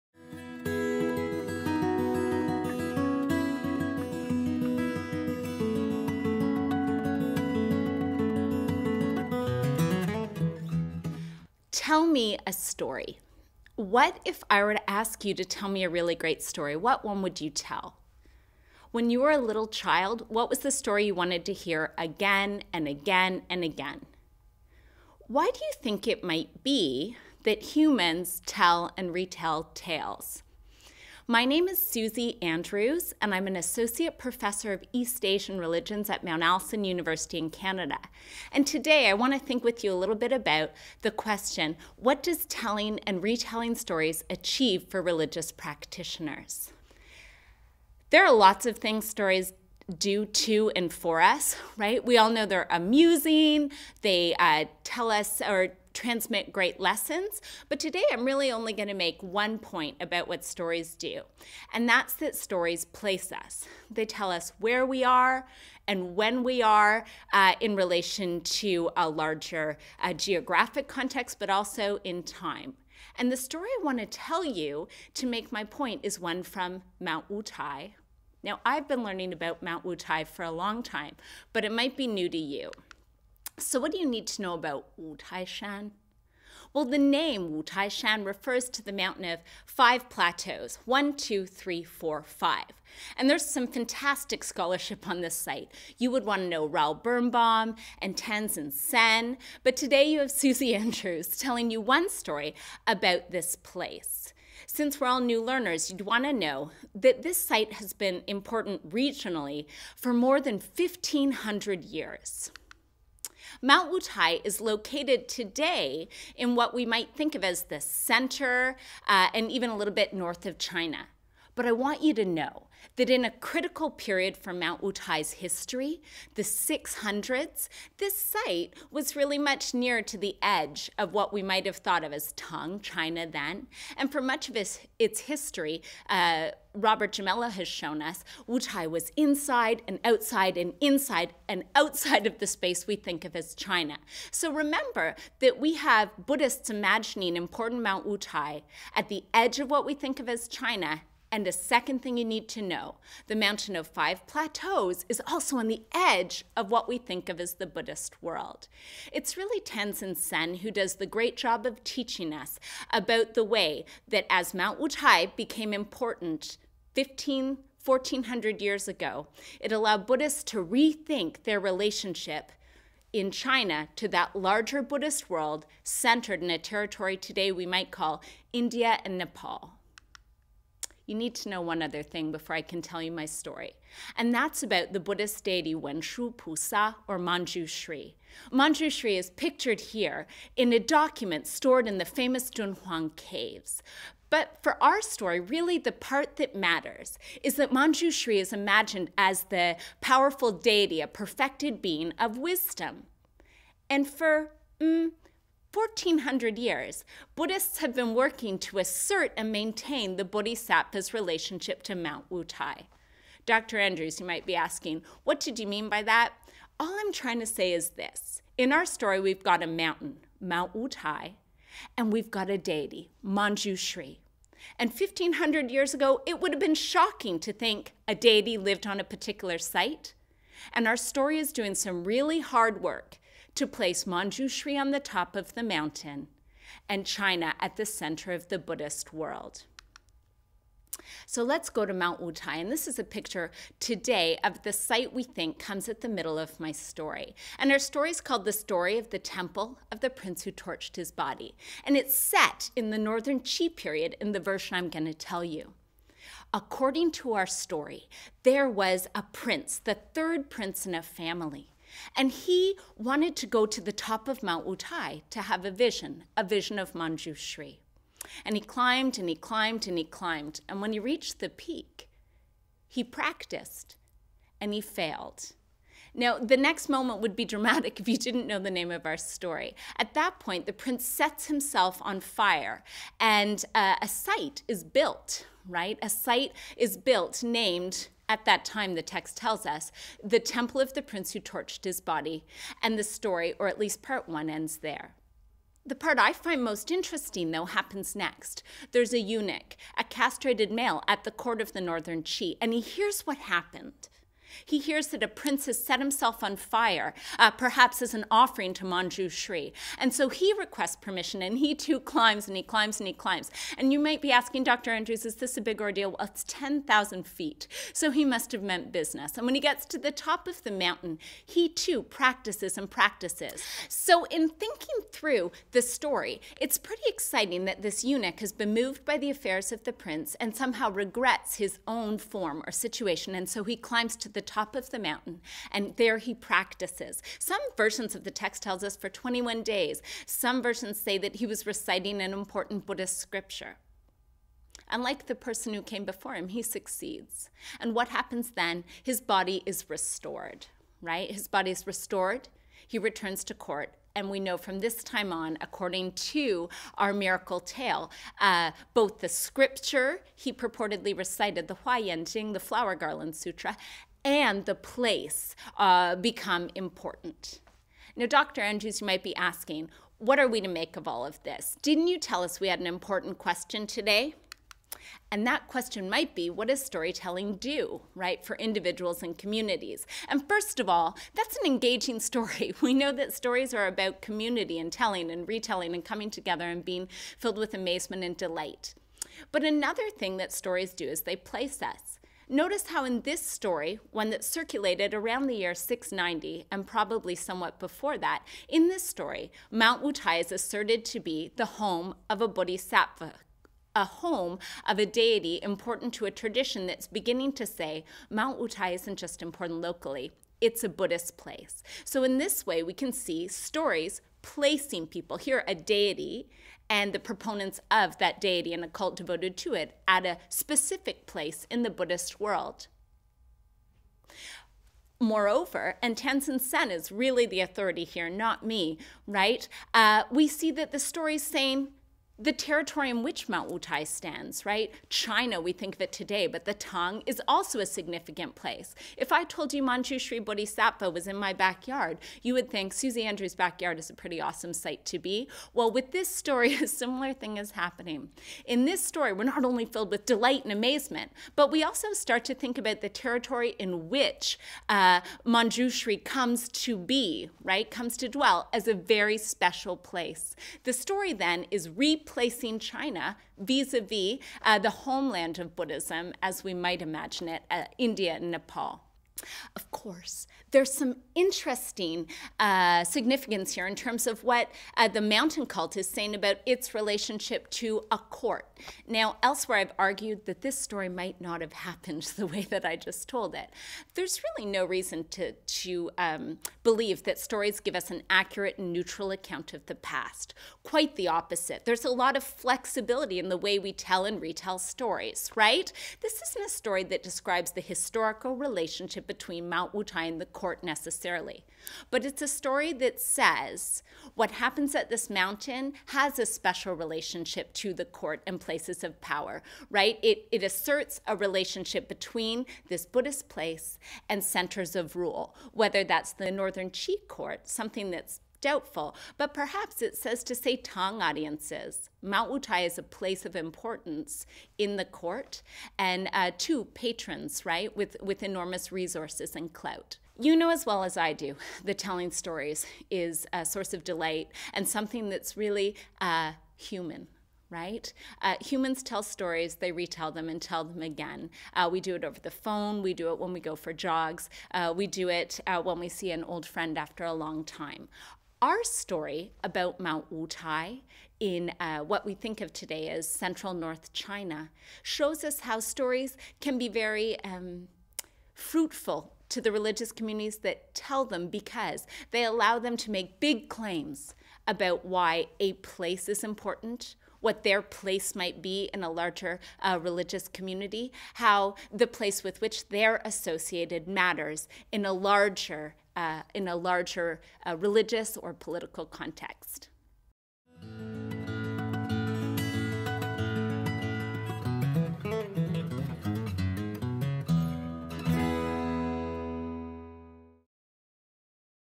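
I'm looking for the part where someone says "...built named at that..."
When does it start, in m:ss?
4:46.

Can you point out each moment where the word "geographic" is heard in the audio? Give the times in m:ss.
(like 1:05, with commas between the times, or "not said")
1:10.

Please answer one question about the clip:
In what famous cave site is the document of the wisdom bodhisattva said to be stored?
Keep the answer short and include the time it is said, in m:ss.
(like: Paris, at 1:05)
Dunhuang Caves, at 3:12.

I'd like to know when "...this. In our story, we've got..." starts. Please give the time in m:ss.
3:37.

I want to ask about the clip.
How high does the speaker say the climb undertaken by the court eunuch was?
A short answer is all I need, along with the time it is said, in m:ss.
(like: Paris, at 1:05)
10,000 feet, at 5:16.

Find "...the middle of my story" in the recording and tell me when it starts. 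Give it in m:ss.
4:06.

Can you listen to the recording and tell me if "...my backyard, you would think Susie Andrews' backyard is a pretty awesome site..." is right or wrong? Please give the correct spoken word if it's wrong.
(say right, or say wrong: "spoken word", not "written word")
right.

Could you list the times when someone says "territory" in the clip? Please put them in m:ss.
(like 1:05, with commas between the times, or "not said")
2:56, 7:12, 7:33.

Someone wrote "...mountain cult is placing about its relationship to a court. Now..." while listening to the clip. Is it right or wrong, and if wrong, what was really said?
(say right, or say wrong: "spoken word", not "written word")
wrong: "saying", not "placing".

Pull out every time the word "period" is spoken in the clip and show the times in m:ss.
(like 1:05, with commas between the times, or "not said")
2:03, 4:13.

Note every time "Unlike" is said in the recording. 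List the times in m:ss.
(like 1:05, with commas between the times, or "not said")
5:44.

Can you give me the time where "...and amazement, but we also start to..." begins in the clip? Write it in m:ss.
7:30.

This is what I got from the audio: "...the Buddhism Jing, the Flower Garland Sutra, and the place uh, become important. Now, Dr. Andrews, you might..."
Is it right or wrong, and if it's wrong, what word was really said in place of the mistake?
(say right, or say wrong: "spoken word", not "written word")
wrong: "Huayan", not "Buddhism".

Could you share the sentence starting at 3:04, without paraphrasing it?
And that's about the Buddhist deity Wenshu Pusa or Manjushri.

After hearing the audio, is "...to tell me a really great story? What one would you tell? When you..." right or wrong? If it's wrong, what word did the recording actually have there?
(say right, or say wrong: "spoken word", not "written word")
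right.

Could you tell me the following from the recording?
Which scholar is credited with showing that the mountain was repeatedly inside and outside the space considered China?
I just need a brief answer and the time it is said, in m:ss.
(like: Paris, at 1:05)
Robert Gimello, at 2:16.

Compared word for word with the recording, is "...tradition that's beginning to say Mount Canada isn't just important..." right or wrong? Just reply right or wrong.
wrong.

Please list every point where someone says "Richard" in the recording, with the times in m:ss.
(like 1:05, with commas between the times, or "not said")
not said.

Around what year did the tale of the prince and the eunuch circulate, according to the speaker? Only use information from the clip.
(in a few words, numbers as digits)
690.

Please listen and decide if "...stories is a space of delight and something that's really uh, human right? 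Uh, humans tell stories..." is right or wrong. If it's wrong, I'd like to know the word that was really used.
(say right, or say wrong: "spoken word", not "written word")
wrong: "source", not "space".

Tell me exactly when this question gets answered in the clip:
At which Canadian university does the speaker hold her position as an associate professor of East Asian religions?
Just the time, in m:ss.
0:36.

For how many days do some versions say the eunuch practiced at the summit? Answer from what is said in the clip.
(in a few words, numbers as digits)
21.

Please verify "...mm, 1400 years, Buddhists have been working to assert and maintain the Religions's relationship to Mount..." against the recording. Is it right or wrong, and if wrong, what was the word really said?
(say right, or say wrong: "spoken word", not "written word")
wrong: "Bodhisattva", not "Religions".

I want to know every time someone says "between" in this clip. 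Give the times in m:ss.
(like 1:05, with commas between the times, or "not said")
8:19, 8:32.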